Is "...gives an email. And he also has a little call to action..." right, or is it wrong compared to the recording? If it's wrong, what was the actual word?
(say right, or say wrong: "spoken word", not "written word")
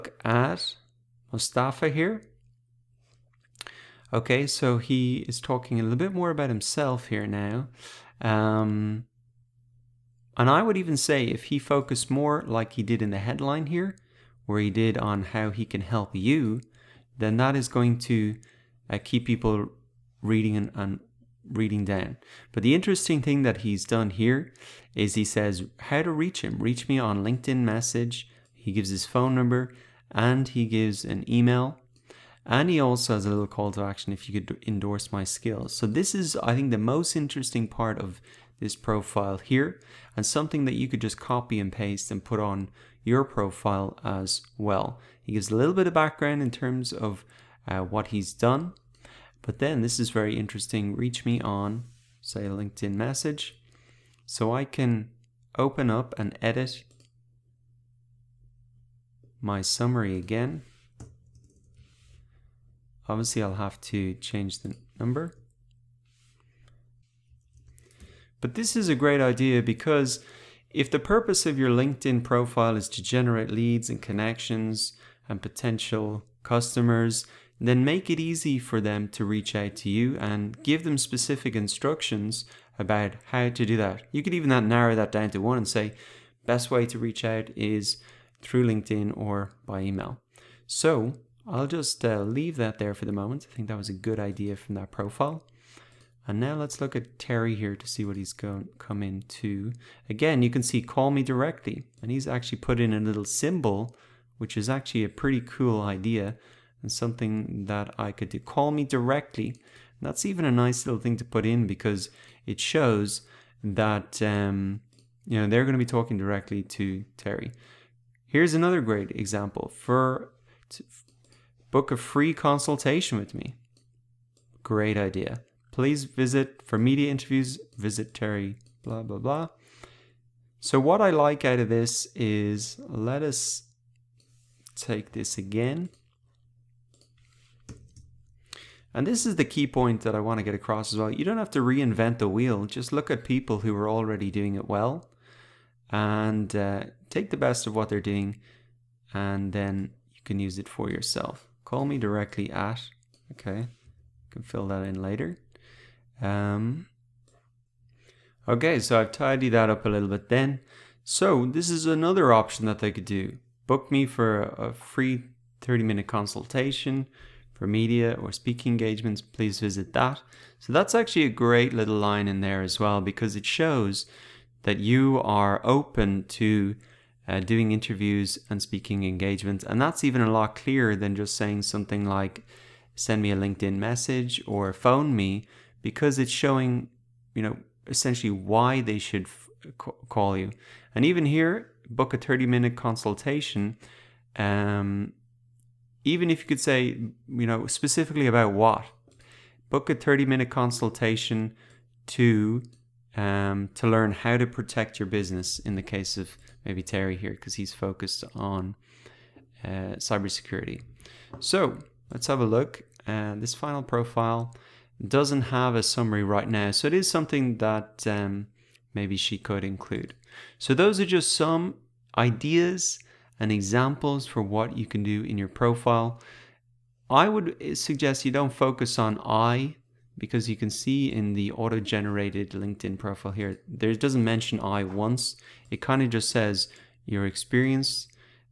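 right.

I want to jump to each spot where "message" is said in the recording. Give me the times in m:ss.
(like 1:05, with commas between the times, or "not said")
0:27, 0:52, 3:03.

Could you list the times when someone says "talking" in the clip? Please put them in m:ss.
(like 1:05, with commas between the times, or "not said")
0:05, 1:55.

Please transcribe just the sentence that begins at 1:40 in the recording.
Again, you can see call me directly.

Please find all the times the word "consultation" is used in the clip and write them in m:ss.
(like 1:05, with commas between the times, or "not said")
2:02, 2:46, 3:12, 3:20.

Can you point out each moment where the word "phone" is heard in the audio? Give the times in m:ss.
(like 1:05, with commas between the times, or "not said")
0:29, 3:04.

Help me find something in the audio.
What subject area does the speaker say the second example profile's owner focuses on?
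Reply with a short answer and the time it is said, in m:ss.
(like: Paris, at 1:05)
Cybersecurity, at 3:29.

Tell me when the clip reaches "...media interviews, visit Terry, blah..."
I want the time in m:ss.
2:06.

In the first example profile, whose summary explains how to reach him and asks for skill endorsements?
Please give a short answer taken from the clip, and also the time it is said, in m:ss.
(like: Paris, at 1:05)
Mustafa, at 0:01.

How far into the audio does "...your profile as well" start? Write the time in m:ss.
0:43.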